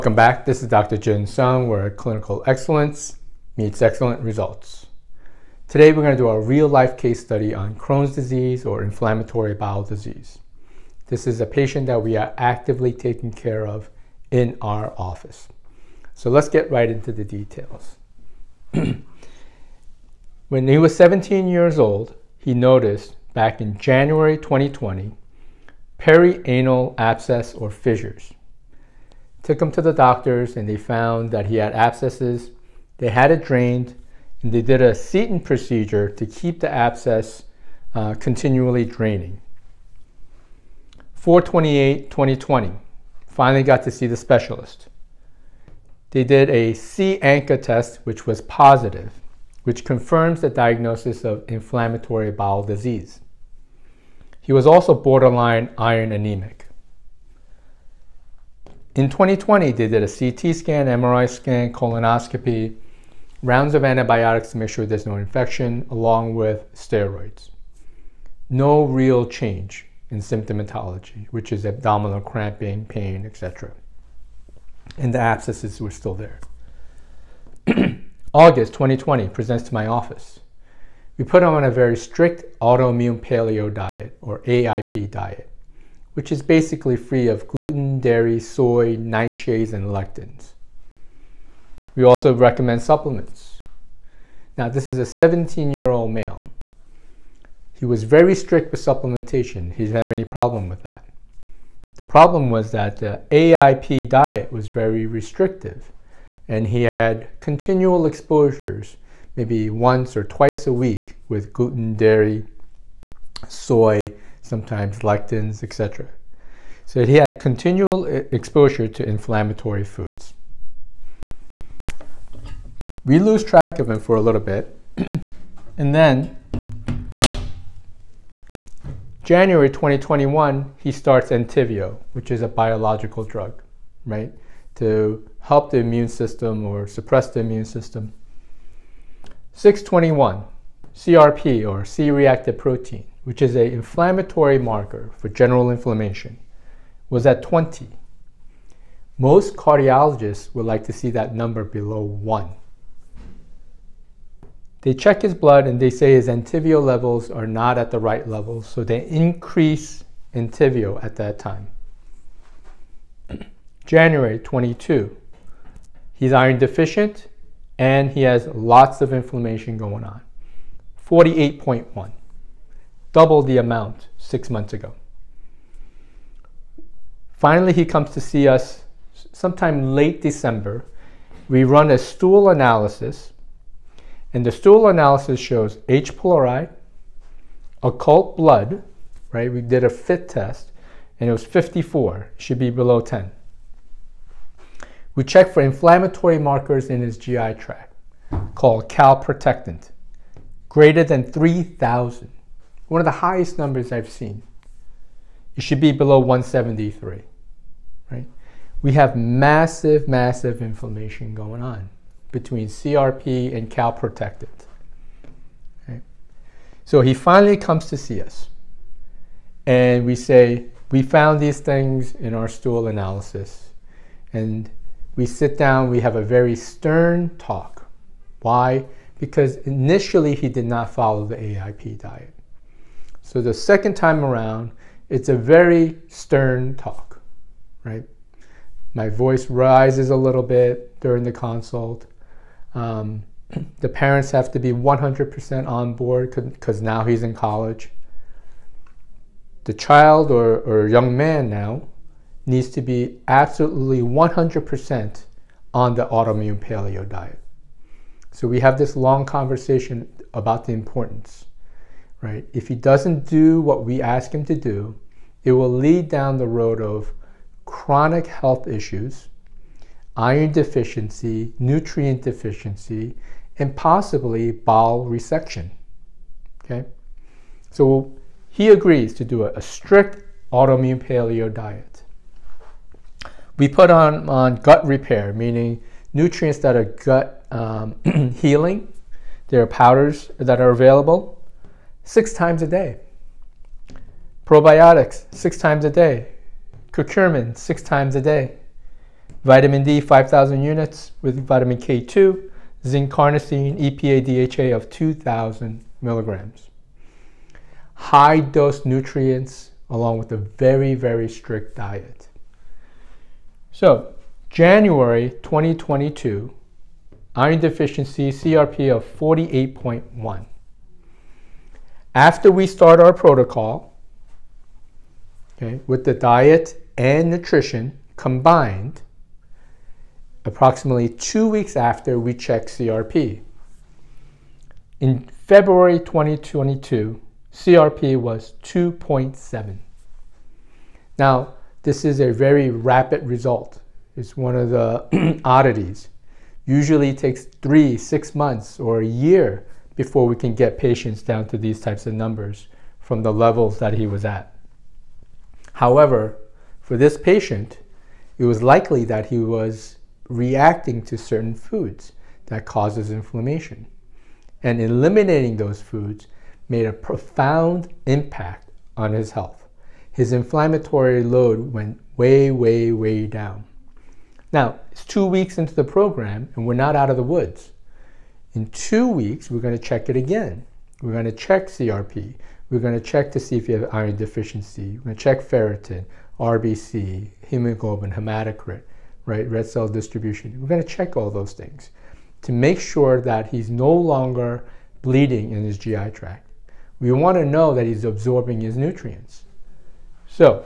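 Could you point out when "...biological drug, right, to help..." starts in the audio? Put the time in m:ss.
2:12.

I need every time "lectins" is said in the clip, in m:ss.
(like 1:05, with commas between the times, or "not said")
1:29, 1:54.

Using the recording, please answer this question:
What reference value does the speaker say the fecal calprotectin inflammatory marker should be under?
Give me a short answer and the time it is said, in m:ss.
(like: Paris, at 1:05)
173, at 3:26.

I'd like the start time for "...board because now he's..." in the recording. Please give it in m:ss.
4:05.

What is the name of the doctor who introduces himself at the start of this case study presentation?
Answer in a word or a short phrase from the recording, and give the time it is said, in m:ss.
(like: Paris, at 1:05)
Dr. Jun Sung, at 0:00.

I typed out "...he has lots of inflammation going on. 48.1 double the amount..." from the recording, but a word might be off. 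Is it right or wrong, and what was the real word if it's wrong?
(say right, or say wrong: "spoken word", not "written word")
right.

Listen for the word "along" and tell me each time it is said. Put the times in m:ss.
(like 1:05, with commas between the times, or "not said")
1:05, 5:09.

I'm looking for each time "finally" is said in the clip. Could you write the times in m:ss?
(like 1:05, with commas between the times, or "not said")
0:43, 2:57, 3:37.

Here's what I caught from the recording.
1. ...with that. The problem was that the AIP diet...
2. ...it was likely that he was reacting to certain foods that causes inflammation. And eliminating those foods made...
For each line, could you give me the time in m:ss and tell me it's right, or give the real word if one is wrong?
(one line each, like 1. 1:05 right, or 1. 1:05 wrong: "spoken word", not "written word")
1. 1:40 right
2. 5:58 right.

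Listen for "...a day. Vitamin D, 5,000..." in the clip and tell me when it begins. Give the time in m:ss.
4:58.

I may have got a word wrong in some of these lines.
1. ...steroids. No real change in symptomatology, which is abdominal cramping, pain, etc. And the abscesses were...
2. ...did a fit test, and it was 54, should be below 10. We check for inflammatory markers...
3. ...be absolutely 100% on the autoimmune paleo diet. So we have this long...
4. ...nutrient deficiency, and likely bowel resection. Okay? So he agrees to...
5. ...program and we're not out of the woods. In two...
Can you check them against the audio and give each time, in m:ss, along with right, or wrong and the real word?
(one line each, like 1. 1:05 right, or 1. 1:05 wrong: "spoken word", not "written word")
1. 1:06 right
2. 3:09 right
3. 4:12 right
4. 4:31 wrong: "possibly", not "likely"
5. 6:15 right.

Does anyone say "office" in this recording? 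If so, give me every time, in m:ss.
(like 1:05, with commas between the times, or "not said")
0:14, 1:19.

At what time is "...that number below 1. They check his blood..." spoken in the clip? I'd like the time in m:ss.
2:31.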